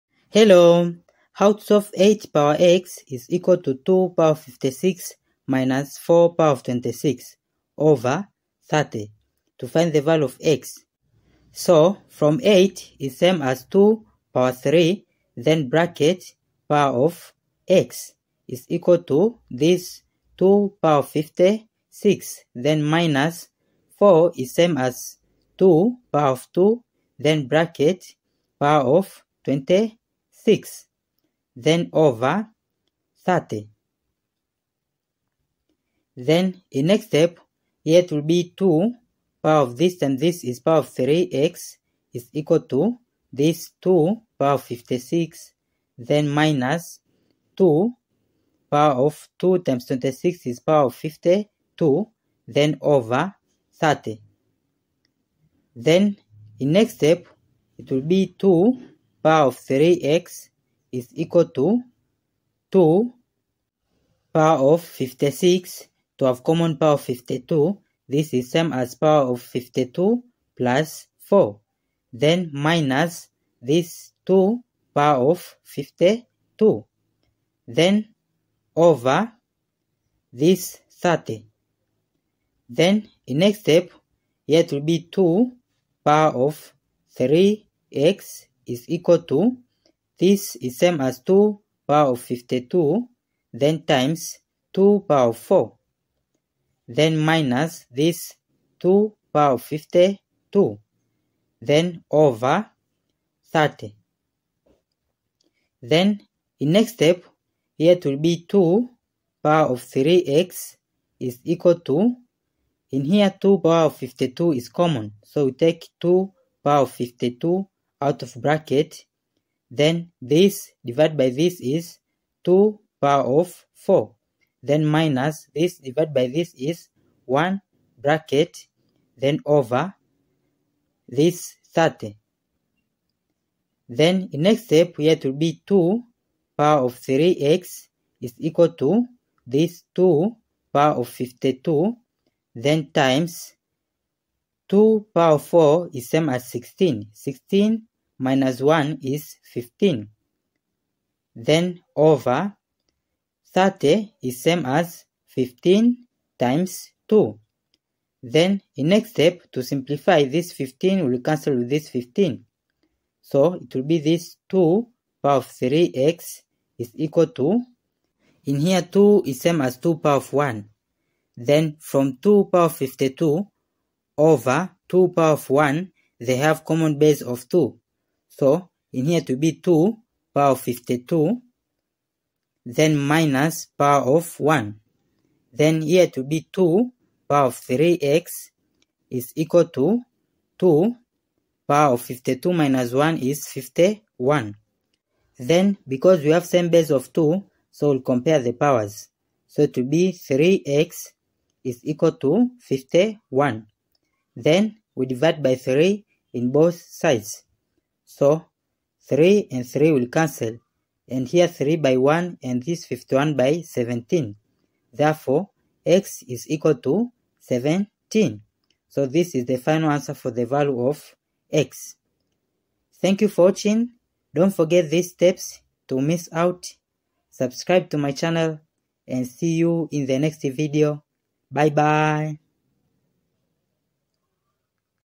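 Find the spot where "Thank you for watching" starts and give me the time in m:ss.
3:43.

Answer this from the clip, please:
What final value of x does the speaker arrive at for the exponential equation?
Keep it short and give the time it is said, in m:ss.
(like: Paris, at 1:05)
17, at 3:35.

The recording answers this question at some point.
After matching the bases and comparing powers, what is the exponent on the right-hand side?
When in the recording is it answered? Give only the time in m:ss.
3:12.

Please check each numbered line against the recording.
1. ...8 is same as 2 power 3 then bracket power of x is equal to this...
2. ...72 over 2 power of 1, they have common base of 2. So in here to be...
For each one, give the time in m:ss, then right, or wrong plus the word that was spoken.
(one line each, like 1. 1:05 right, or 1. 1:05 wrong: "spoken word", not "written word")
1. 0:12 right
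2. 2:52 wrong: "52", not "72".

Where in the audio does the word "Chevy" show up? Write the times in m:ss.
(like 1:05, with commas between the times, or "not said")
not said.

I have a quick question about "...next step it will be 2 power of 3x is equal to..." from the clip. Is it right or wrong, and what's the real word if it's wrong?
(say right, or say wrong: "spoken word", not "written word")
right.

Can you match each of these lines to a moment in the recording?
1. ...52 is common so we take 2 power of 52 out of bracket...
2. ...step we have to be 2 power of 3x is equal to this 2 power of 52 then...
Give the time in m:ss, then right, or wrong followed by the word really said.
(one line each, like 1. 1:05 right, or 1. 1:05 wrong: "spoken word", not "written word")
1. 1:53 right
2. 2:14 right.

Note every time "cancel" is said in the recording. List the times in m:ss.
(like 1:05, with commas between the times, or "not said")
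2:41, 3:30.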